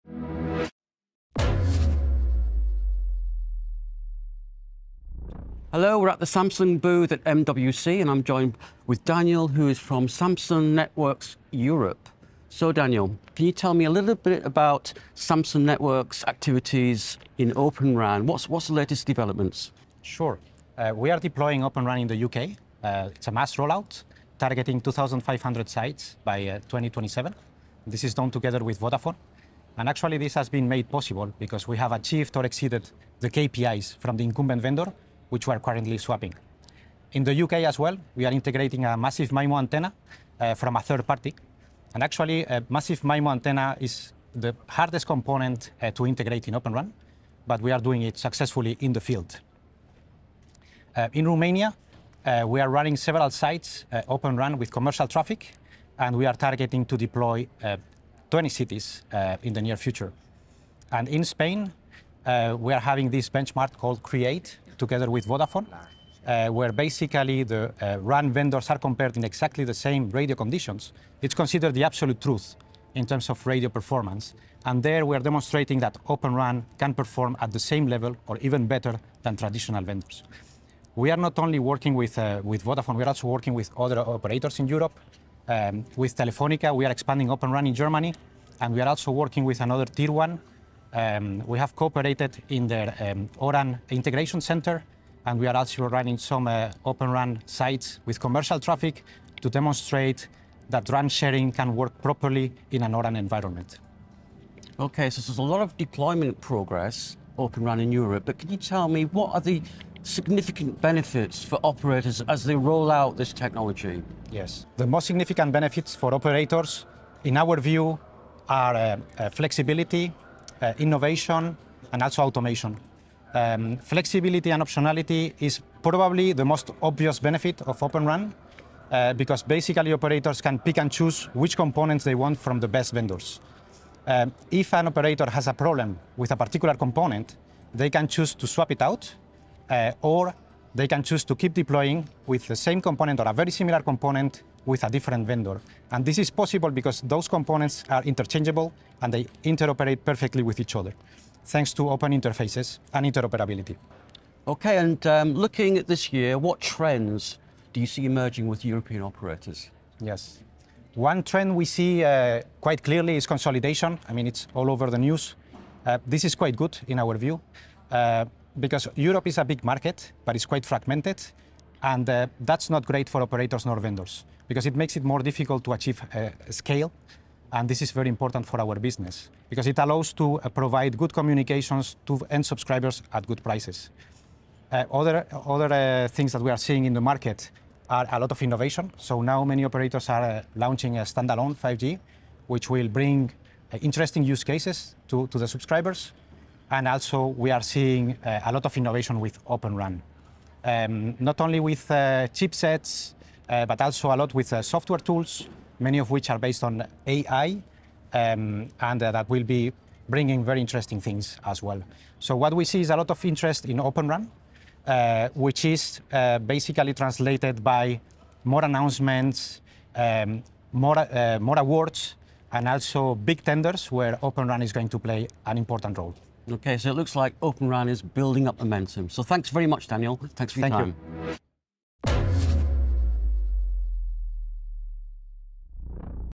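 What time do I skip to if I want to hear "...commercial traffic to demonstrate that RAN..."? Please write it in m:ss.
1:38.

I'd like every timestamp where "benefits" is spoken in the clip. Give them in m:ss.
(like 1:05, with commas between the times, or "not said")
1:50, 1:55, 2:07.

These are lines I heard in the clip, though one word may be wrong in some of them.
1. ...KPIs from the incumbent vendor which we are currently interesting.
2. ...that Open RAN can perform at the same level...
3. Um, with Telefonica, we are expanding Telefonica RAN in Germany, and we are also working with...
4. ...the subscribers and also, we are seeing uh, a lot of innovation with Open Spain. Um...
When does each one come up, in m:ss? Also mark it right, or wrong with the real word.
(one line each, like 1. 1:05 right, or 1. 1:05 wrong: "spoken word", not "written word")
1. 0:33 wrong: "swapping", not "interesting"
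2. 1:15 right
3. 1:25 wrong: "Open", not "Telefonica"
4. 3:15 wrong: "RAN", not "Spain".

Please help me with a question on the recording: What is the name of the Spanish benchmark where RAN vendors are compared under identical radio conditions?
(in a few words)
CREATE.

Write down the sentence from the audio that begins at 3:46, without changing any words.
Okay, so it looks like Open RAN is building up momentum.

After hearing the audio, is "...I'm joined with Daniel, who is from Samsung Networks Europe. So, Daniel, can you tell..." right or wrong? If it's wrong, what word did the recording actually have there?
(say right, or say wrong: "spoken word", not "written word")
right.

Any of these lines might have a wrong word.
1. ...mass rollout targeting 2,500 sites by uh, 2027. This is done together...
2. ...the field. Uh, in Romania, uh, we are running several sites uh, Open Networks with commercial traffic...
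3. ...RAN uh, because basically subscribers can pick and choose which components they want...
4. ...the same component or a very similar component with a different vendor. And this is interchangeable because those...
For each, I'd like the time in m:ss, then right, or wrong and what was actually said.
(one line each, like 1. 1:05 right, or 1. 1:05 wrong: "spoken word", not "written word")
1. 0:23 right
2. 0:48 wrong: "RAN", not "Networks"
3. 2:08 wrong: "operators", not "subscribers"
4. 2:22 wrong: "possible", not "interchangeable".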